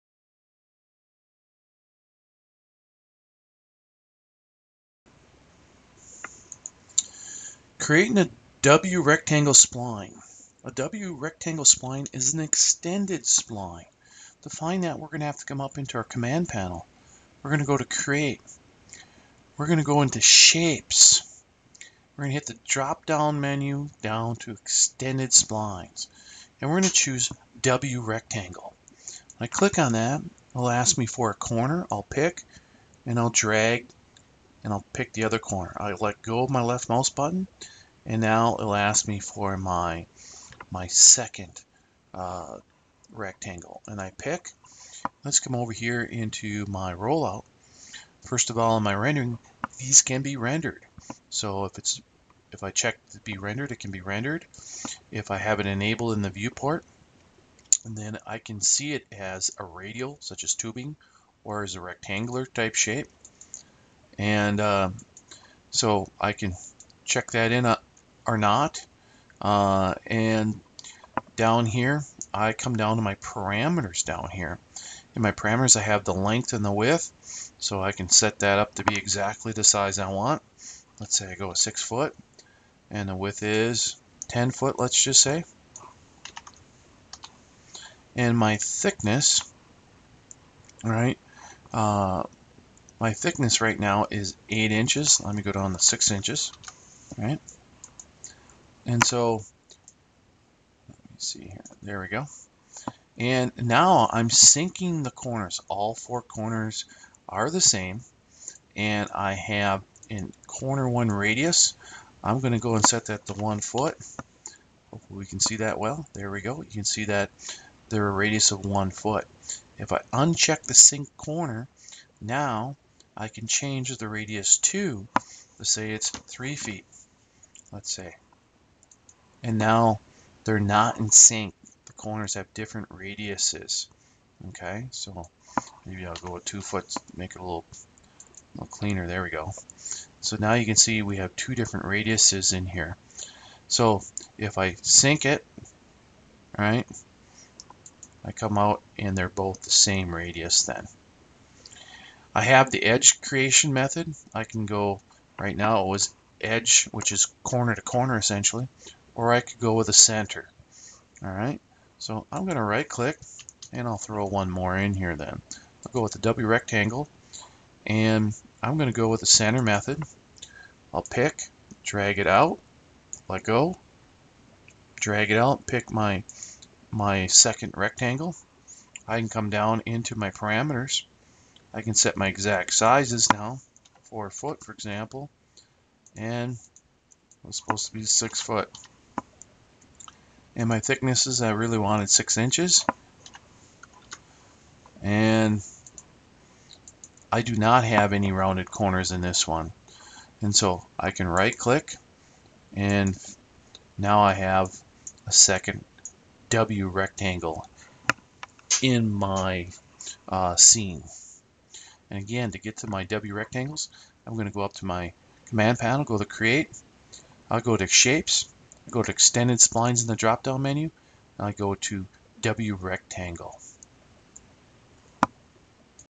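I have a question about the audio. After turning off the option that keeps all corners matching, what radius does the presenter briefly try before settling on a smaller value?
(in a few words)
3 feet.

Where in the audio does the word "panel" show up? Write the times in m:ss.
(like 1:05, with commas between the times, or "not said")
0:16, 3:35.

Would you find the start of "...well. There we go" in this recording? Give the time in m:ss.
1:55.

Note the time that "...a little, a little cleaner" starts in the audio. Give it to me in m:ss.
2:17.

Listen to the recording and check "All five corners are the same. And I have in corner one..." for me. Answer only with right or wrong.
wrong.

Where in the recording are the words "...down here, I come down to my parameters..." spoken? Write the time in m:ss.
1:11.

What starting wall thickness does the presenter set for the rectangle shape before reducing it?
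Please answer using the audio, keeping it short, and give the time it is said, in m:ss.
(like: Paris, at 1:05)
8 inches, at 1:34.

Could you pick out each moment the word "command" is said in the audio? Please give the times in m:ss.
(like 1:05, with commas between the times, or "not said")
0:16, 3:35.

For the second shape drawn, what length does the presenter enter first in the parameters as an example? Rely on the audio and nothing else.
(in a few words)
4 feet.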